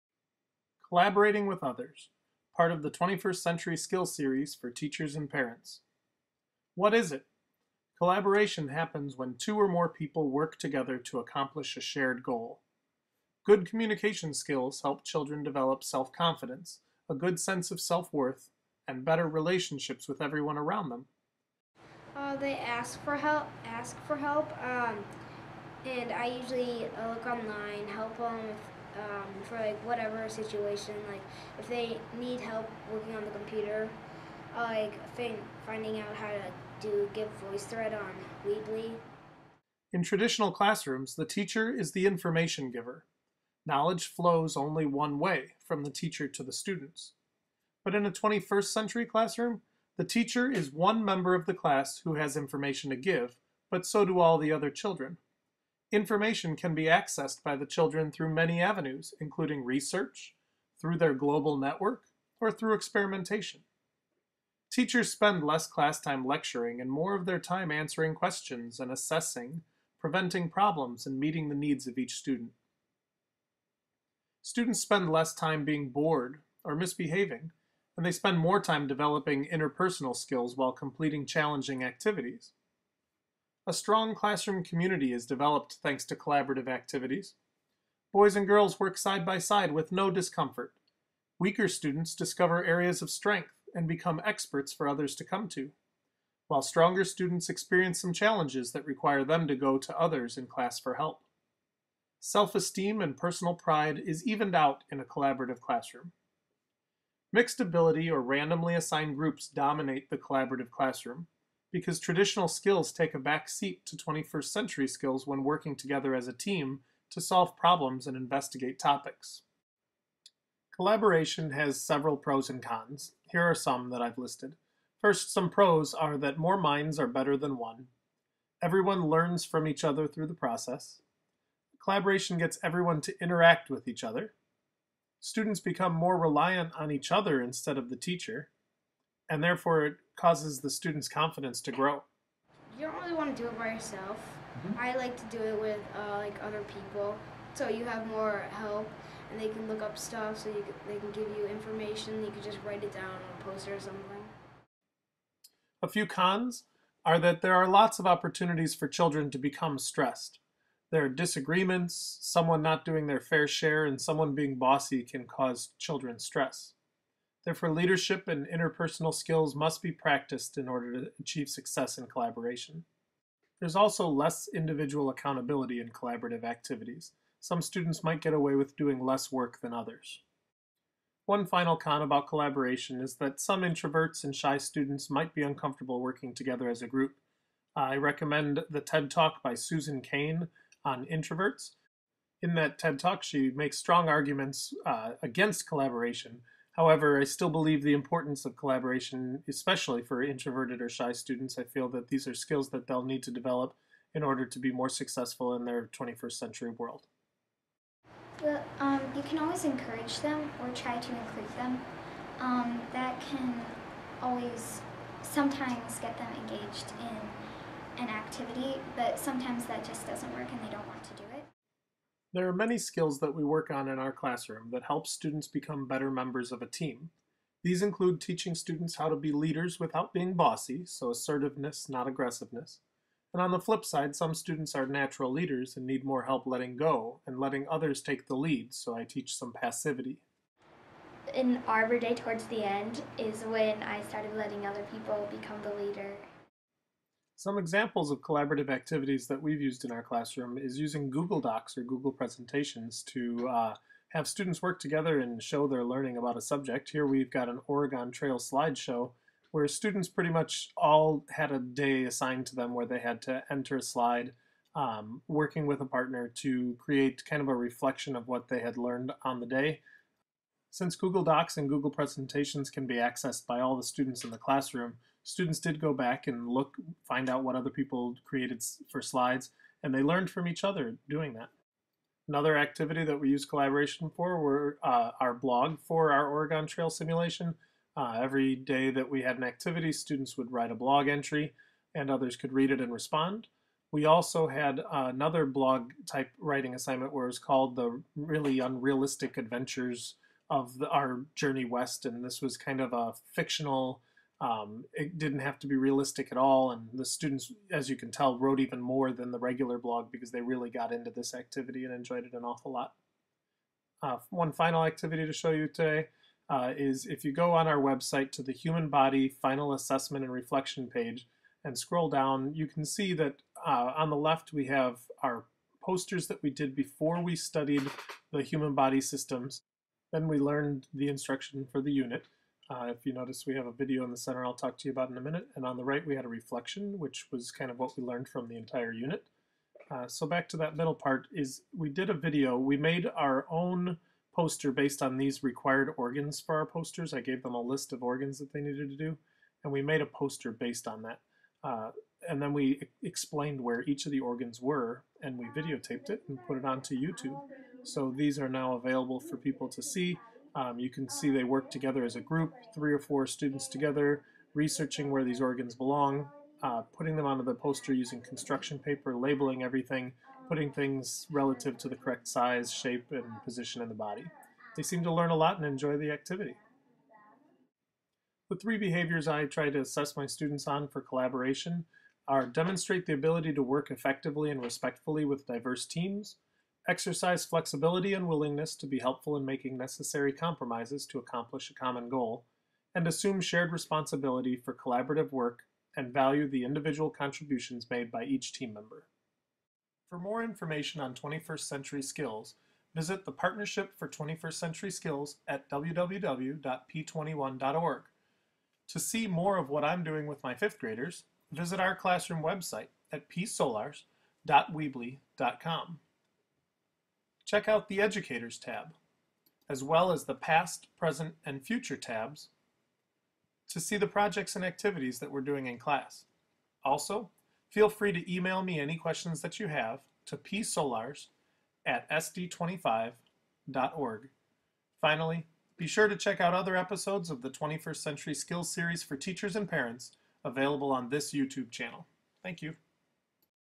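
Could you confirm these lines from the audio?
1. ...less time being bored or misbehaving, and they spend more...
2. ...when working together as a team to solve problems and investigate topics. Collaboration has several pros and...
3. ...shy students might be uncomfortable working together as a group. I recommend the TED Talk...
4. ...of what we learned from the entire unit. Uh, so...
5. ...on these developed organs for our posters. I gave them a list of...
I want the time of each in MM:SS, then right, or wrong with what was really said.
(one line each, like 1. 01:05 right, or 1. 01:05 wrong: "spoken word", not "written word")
1. 01:15 right
2. 01:55 right
3. 03:04 right
4. 05:37 right
5. 05:45 wrong: "required", not "developed".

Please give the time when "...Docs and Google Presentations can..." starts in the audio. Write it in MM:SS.
04:31.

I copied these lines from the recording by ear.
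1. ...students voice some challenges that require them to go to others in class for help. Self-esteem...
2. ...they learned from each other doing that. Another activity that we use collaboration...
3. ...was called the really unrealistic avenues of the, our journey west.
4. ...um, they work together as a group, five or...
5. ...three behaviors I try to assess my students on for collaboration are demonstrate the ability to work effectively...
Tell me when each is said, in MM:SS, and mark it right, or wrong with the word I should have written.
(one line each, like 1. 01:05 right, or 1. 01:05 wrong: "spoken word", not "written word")
1. 01:37 wrong: "experience", not "voice"
2. 04:39 right
3. 04:57 wrong: "adventures", not "avenues"
4. 06:01 wrong: "three", not "five"
5. 06:18 right.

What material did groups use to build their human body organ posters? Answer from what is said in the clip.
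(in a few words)
construction paper.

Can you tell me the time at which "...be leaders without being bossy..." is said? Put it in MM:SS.
03:49.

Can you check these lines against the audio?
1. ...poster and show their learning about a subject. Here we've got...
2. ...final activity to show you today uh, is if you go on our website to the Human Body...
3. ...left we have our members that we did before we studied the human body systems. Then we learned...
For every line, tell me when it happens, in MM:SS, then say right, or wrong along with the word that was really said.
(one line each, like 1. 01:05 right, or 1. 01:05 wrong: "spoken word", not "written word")
1. 04:14 wrong: "together", not "poster"
2. 05:14 right
3. 05:24 wrong: "posters", not "members".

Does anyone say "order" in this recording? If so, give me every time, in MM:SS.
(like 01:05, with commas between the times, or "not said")
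02:50, 03:24.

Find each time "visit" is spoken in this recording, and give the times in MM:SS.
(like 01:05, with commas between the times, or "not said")
06:42, 06:51.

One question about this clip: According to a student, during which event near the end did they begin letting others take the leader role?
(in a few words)
Arbor Day.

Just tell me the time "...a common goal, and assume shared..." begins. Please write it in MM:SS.
06:31.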